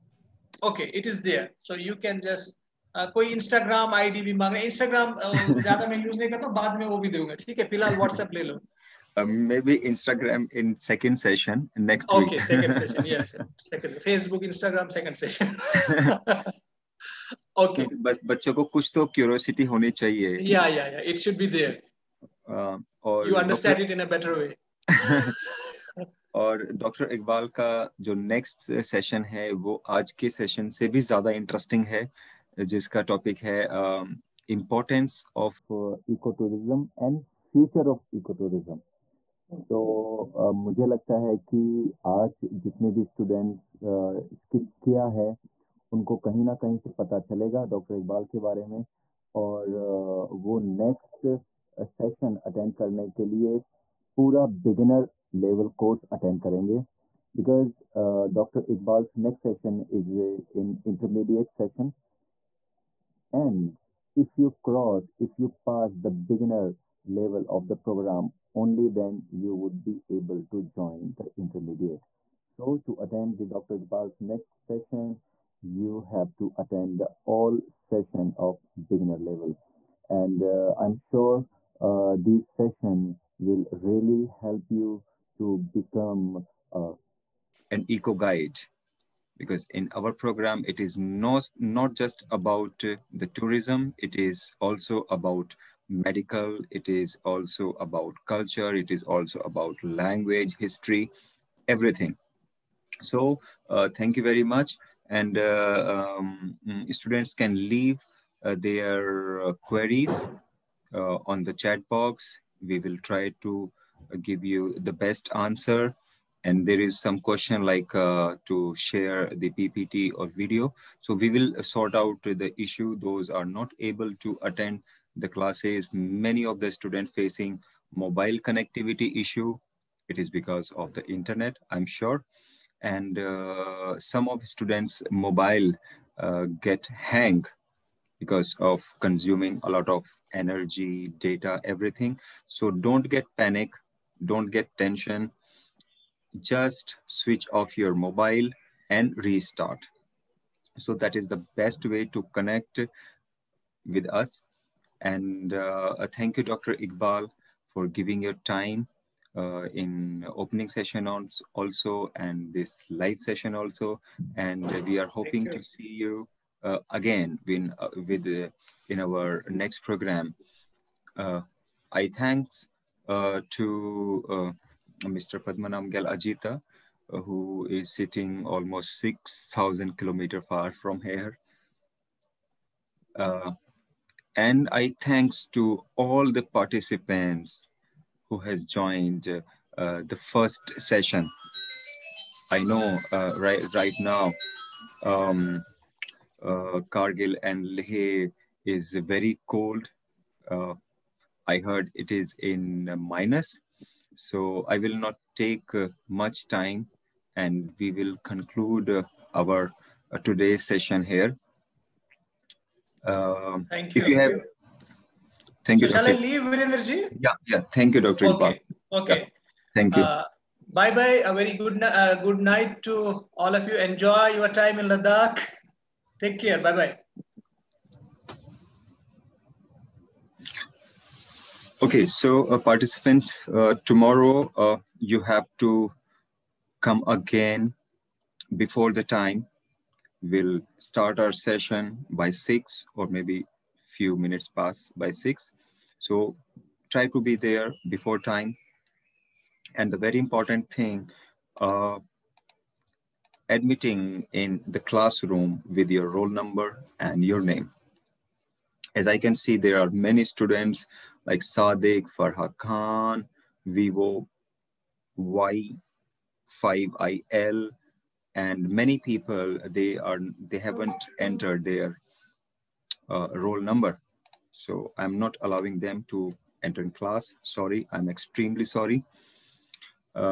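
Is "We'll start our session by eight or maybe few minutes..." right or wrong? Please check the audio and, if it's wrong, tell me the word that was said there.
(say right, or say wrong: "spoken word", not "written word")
wrong: "six", not "eight".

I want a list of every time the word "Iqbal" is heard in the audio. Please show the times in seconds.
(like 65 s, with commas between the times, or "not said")
58 s, 73 s, 156 s.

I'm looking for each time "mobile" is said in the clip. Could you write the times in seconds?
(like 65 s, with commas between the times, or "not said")
127 s, 135 s, 147 s.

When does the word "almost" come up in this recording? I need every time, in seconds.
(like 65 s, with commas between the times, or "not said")
178 s.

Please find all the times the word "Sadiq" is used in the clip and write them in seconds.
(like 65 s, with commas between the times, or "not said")
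261 s.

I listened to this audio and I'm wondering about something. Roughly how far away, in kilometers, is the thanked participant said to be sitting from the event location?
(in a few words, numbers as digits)
6,000.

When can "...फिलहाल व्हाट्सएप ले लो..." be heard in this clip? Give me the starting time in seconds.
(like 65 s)
7 s.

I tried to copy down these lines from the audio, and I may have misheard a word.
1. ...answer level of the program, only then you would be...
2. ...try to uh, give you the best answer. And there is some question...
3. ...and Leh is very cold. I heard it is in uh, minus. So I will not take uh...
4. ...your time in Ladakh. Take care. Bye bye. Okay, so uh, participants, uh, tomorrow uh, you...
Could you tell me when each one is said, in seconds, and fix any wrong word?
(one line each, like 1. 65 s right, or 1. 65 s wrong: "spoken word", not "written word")
1. 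66 s wrong: "beginner", not "answer"
2. 113 s right
3. 197 s right
4. 224 s right.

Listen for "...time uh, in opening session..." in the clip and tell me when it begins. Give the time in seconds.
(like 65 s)
158 s.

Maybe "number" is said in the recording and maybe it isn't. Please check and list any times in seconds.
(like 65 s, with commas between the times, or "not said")
256 s, 273 s.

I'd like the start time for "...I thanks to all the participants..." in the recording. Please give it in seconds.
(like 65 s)
184 s.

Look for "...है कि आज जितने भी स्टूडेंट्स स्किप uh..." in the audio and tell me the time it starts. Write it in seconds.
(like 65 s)
41 s.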